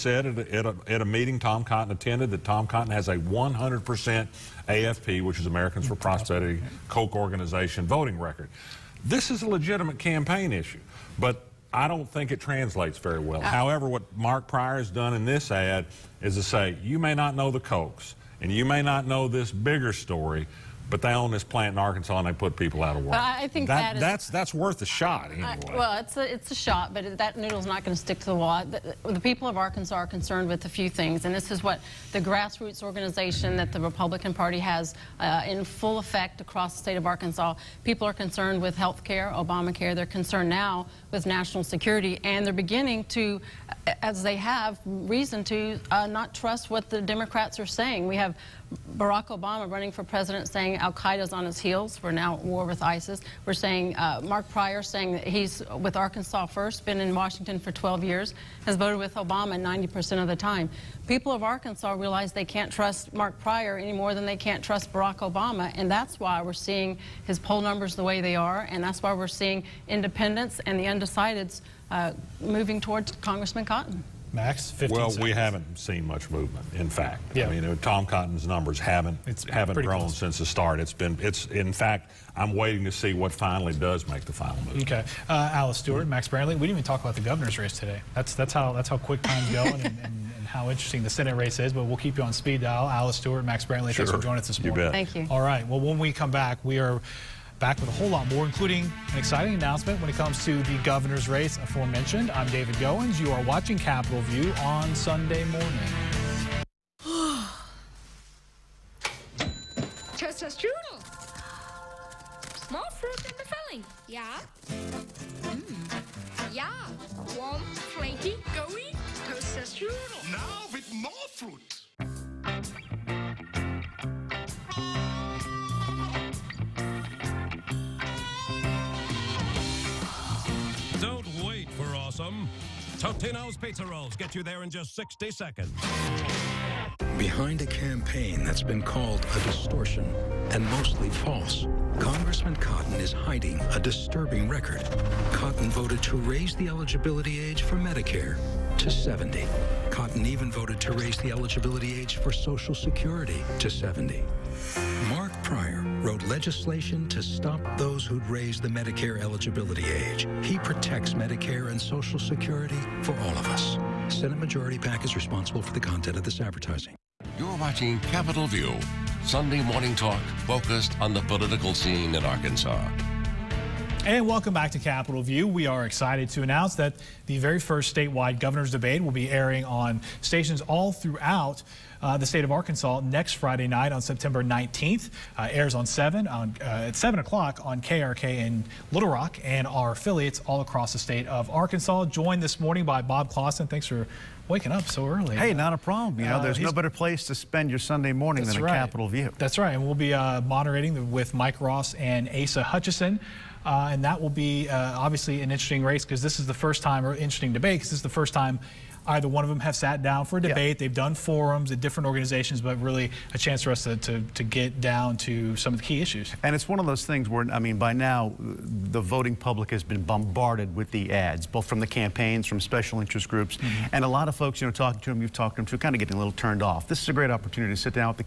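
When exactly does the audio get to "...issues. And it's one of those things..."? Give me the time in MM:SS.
03:36.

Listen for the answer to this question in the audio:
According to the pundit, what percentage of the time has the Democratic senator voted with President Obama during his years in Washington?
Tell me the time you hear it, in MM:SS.
00:59.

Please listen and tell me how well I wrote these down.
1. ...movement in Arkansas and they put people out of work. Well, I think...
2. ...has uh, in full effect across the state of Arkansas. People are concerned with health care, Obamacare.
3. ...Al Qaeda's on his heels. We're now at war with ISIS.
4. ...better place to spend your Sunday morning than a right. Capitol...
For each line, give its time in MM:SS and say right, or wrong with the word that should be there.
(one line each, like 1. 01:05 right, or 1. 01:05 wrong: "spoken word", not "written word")
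1. 00:21 wrong: "plant", not "movement"
2. 00:34 right
3. 00:50 right
4. 03:16 right.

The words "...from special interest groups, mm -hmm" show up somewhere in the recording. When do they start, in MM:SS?
03:42.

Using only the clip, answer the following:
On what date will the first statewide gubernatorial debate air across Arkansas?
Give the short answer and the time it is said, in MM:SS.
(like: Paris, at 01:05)
September 19th, at 03:04.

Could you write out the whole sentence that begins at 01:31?
But we'll keep you on speed dial.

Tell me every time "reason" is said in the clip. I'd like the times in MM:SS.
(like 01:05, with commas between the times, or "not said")
00:44.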